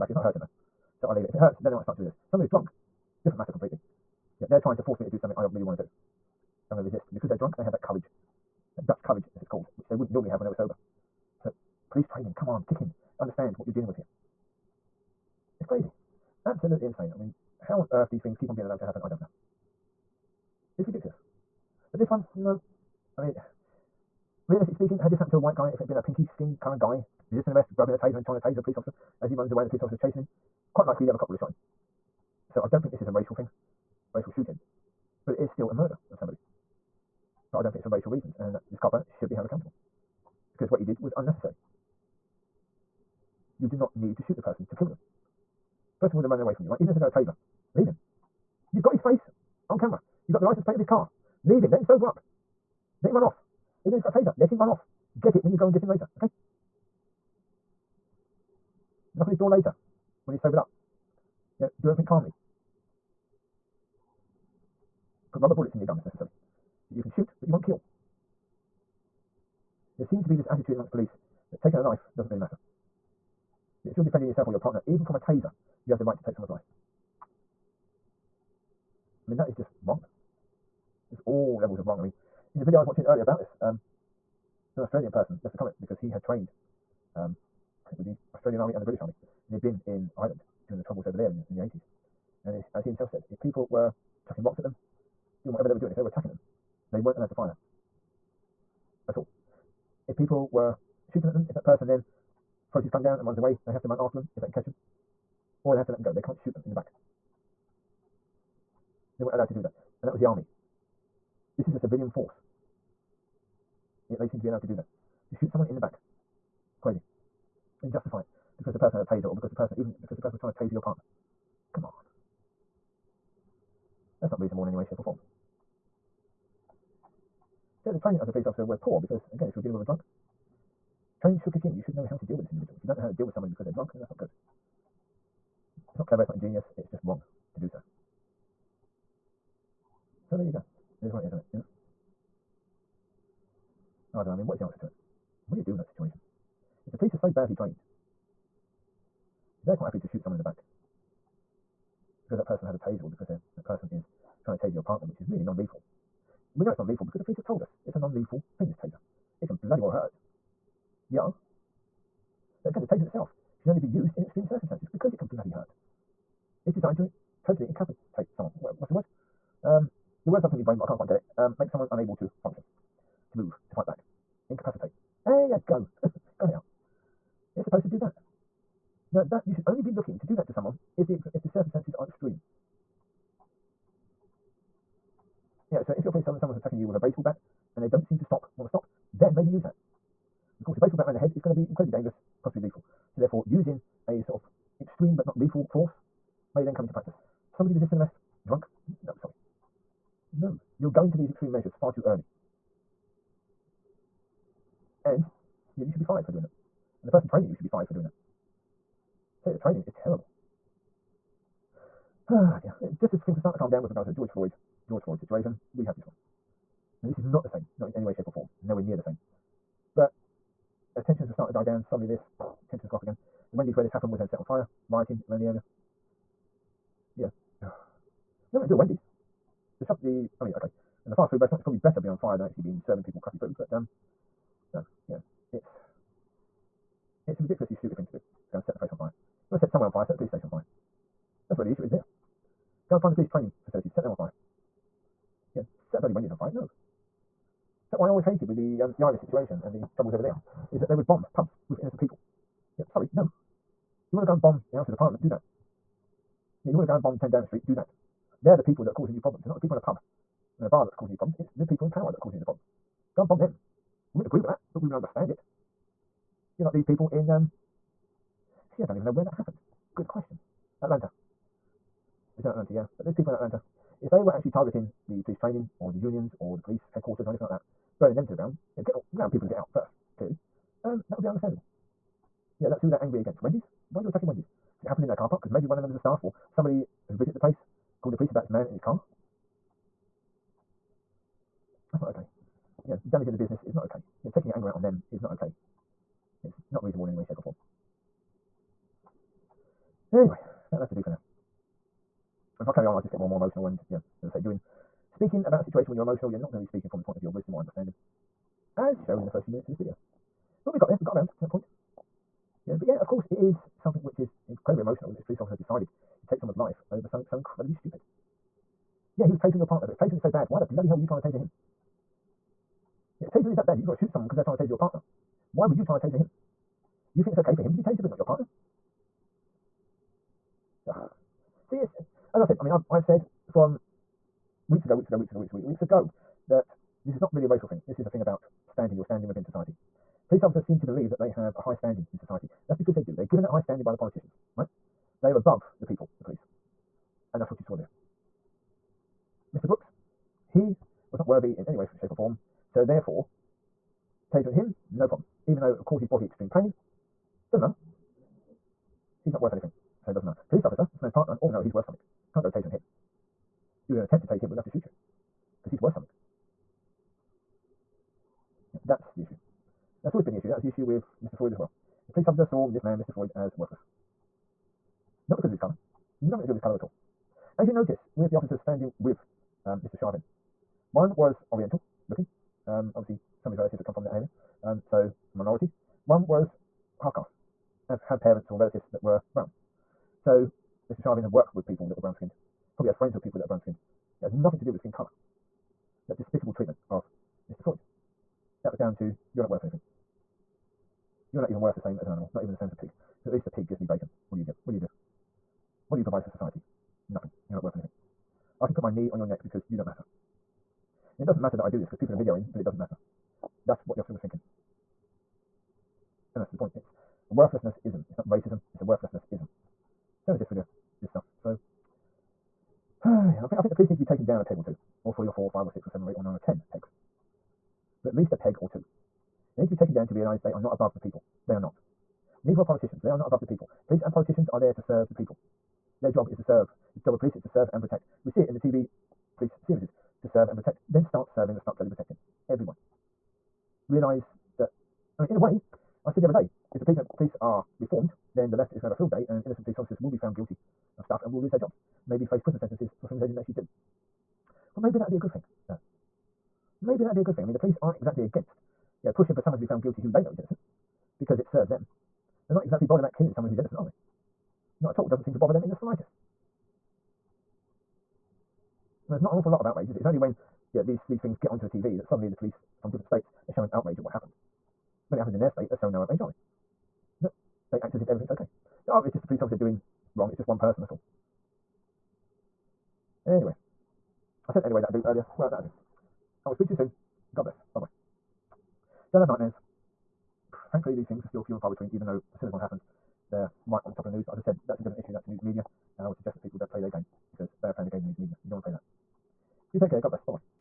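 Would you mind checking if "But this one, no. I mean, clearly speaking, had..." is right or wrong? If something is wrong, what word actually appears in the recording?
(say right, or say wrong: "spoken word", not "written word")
wrong: "realistically", not "clearly".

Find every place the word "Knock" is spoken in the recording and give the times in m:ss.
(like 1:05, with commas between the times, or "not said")
0:59.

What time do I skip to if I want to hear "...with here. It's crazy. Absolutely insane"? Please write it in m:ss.
0:13.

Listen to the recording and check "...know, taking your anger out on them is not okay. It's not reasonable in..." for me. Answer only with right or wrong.
right.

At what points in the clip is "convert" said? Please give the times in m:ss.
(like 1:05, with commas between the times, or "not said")
not said.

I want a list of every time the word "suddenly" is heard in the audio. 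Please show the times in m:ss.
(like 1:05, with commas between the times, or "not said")
3:41, 7:52.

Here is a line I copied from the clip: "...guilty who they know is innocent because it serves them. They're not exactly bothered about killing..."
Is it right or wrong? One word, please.
right.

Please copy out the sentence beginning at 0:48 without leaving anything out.
You've got his face on camera.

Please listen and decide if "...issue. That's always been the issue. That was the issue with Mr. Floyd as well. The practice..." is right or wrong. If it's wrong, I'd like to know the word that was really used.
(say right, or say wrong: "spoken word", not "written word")
wrong: "police", not "practice".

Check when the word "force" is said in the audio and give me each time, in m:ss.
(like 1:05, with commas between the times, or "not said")
0:04, 1:52, 3:15.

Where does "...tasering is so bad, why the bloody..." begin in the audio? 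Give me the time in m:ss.
5:19.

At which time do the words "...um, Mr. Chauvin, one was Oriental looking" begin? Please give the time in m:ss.
6:19.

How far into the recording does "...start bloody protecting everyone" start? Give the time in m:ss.
7:21.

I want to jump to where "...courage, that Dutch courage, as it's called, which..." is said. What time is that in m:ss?
0:07.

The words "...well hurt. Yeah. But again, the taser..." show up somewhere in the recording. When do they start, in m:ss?
2:39.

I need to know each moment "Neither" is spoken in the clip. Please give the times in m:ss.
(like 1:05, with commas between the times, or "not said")
7:12.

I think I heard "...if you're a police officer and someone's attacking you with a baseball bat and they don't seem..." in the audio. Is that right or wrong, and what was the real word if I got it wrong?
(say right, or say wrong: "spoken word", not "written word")
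right.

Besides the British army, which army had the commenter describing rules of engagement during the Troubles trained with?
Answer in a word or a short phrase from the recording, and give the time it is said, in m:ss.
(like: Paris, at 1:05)
Australian Army, at 1:28.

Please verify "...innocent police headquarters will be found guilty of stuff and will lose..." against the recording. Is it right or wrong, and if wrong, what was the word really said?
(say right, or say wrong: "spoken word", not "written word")
wrong: "officers", not "headquarters".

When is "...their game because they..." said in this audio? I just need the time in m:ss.
8:16.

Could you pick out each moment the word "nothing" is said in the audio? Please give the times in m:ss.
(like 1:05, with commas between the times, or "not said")
3:48, 6:16, 6:34, 6:47.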